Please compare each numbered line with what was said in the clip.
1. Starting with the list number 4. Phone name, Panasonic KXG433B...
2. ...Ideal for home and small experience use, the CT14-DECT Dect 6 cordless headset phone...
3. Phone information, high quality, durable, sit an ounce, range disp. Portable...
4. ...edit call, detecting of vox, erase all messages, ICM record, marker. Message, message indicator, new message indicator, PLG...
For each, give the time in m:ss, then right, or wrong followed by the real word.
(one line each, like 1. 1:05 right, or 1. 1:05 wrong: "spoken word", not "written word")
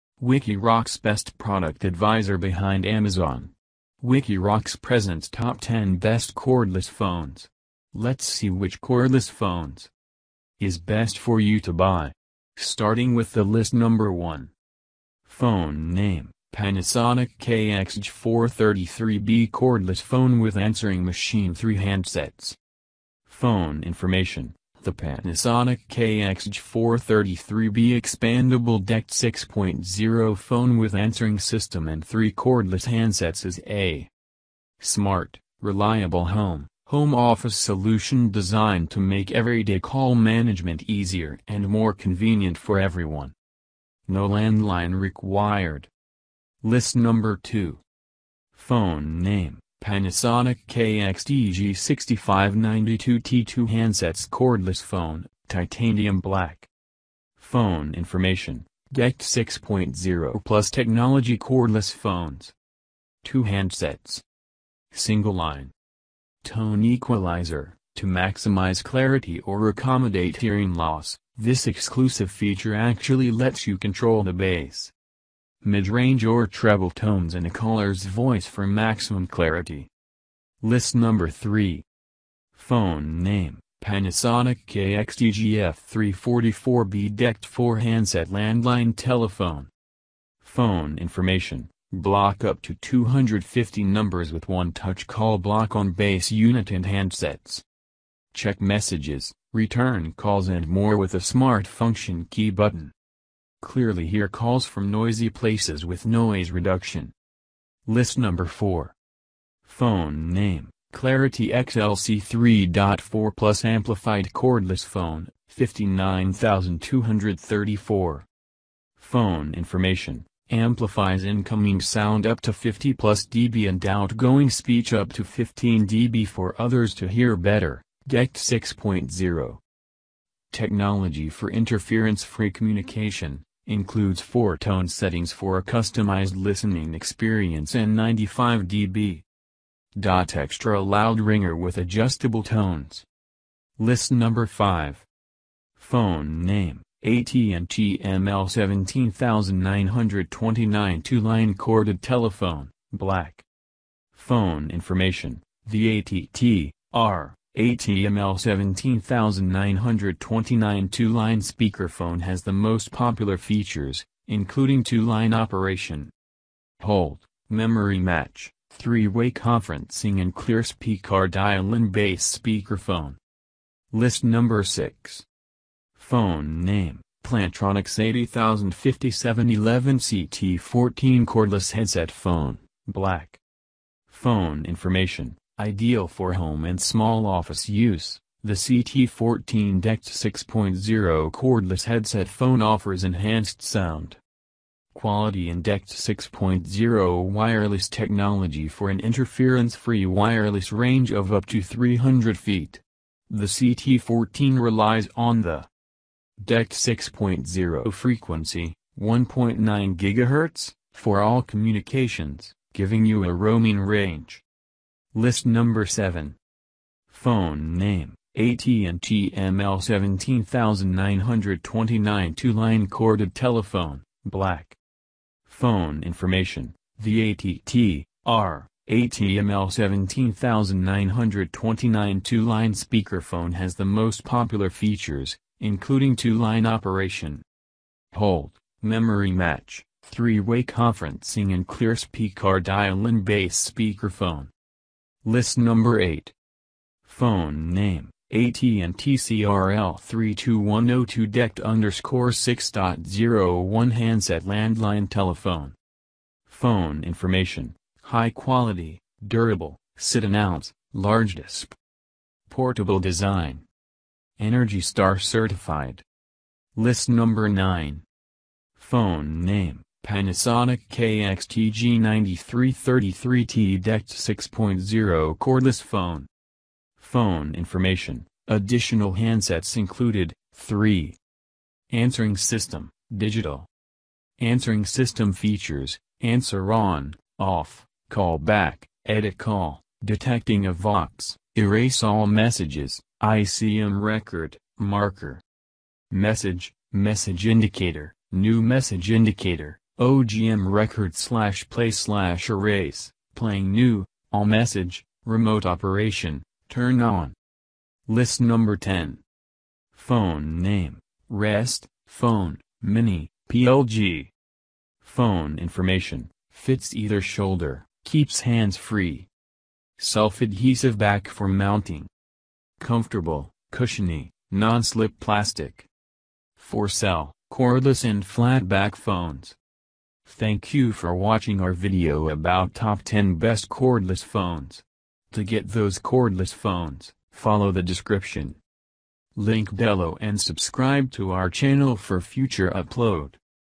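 1. 0:12 wrong: "1", not "4"
2. 3:05 wrong: "office", not "experience"
3. 4:16 wrong: "large", not "range"
4. 4:49 wrong: "OGM", not "PLG".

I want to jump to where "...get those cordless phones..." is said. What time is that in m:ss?
5:35.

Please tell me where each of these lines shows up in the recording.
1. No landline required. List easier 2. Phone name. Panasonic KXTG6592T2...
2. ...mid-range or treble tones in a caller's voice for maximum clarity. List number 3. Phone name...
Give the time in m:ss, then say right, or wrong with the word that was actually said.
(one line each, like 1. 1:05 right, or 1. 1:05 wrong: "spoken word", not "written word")
1. 0:44 wrong: "number", not "easier"
2. 1:15 right.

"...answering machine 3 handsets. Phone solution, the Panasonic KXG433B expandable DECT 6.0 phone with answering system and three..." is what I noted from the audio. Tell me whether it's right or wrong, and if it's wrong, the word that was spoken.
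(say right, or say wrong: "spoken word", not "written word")
wrong: "information", not "solution".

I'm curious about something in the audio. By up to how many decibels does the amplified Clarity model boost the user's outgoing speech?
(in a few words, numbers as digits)
15 dB.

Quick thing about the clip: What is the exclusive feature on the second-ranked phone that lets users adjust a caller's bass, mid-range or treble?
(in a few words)
Tone equalizer.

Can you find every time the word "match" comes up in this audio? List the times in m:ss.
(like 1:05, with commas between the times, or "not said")
2:47, 3:59.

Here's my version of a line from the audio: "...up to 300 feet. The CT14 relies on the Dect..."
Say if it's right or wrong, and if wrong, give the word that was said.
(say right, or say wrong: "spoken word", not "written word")
right.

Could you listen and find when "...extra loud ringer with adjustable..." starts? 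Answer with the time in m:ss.
2:20.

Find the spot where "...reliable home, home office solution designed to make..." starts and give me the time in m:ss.
0:35.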